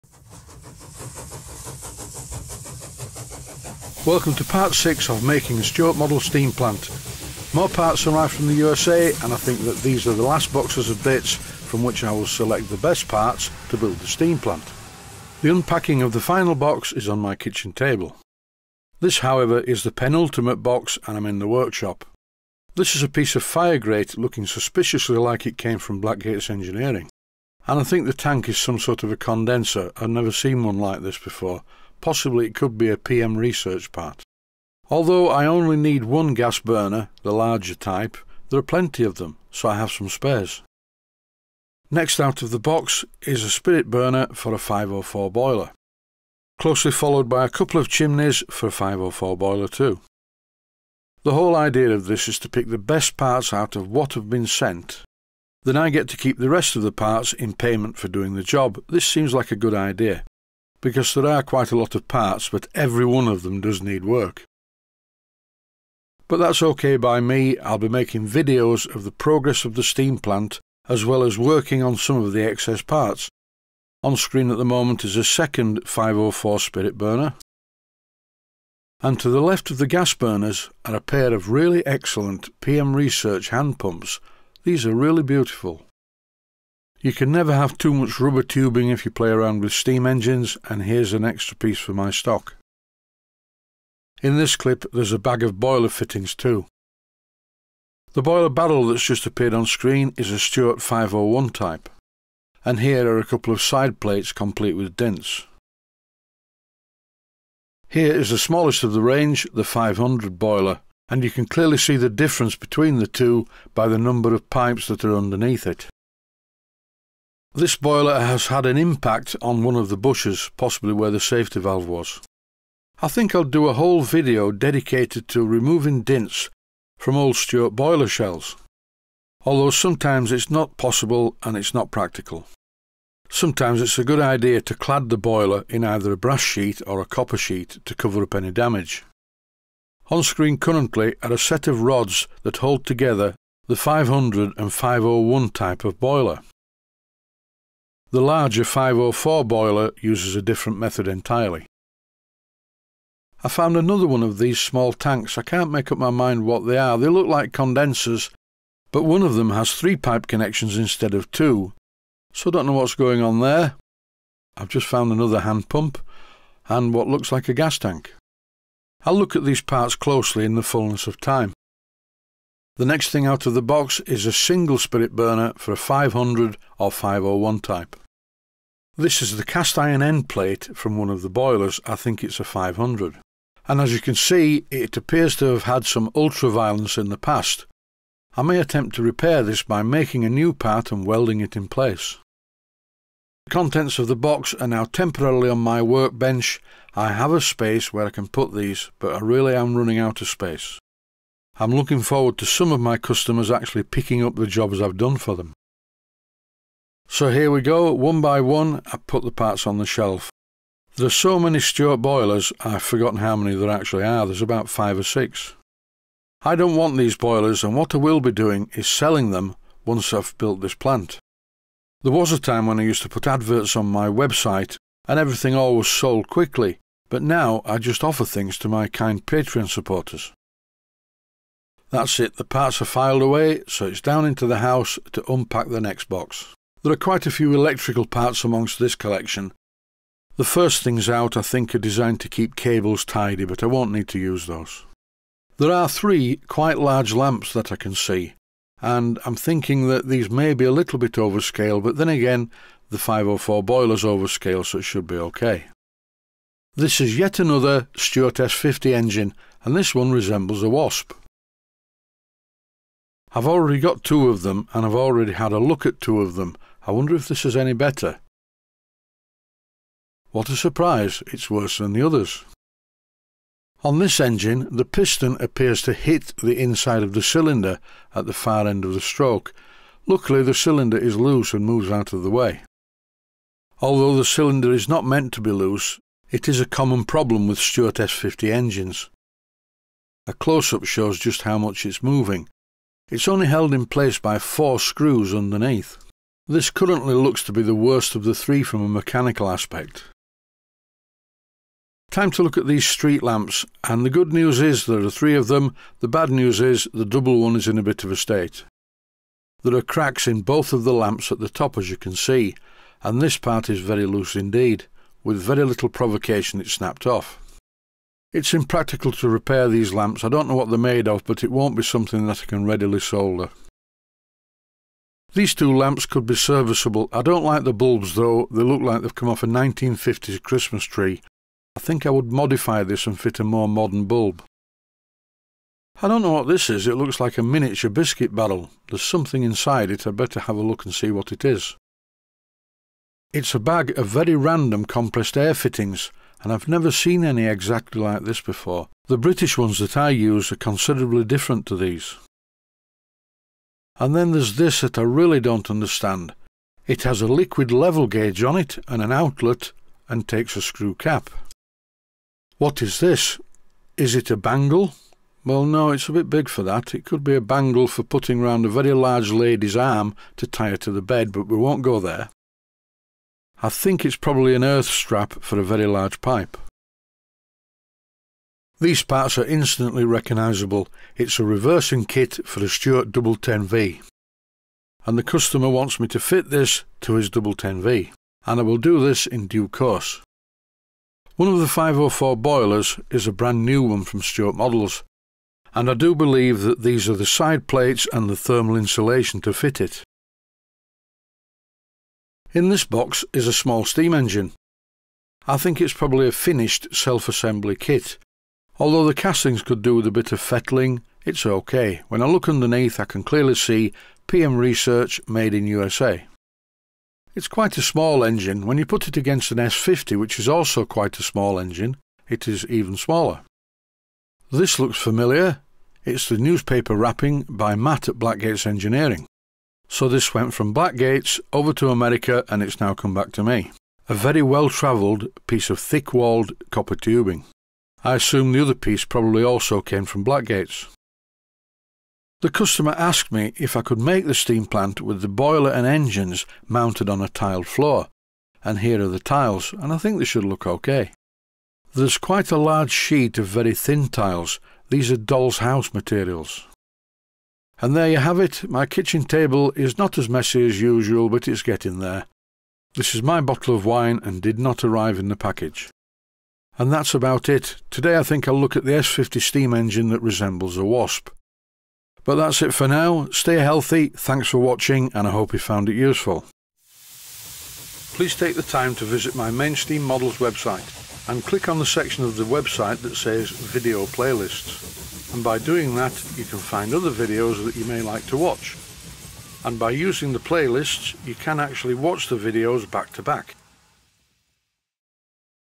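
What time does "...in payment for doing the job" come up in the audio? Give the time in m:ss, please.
0:57.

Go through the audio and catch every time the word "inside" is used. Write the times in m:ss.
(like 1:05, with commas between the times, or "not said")
4:36, 5:39.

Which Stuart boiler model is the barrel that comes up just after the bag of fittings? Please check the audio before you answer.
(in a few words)
Stuart 501.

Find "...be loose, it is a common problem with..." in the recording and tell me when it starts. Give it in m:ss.
4:45.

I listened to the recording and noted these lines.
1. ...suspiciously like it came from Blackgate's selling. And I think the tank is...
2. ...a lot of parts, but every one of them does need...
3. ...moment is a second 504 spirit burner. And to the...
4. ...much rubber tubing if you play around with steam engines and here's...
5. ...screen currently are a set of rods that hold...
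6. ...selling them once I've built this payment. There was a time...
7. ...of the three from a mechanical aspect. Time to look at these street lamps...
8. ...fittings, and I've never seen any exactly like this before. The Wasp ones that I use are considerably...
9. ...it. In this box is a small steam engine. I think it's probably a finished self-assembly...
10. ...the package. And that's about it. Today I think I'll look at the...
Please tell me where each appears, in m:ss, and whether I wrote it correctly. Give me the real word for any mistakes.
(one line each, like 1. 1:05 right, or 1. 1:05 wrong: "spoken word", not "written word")
1. 0:24 wrong: "engineering", not "selling"
2. 1:01 right
3. 1:14 right
4. 1:27 right
5. 2:20 right
6. 3:38 wrong: "plant", not "payment"
7. 4:58 right
8. 5:45 wrong: "British", not "Wasp"
9. 6:39 right
10. 7:45 right.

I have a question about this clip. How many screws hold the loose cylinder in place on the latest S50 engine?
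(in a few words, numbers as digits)
Four.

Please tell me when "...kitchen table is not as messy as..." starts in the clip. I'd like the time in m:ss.
7:38.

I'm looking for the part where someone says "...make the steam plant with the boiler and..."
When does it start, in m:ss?
7:23.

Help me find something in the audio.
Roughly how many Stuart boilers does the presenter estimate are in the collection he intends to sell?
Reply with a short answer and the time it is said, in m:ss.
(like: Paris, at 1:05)
Five or six, at 3:34.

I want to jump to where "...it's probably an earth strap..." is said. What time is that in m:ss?
6:14.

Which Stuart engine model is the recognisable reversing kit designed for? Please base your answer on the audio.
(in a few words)
1010V.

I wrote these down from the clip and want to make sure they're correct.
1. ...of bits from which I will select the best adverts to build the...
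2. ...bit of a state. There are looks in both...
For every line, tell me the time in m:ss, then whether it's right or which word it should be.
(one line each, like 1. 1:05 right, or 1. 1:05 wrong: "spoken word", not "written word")
1. 0:10 wrong: "parts", not "adverts"
2. 5:07 wrong: "cracks", not "looks".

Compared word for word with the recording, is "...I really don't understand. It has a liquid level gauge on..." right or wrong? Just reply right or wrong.
right.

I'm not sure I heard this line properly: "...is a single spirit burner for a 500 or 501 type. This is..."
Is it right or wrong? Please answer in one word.
right.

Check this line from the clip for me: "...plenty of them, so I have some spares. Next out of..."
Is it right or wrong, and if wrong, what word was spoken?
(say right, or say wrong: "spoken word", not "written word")
right.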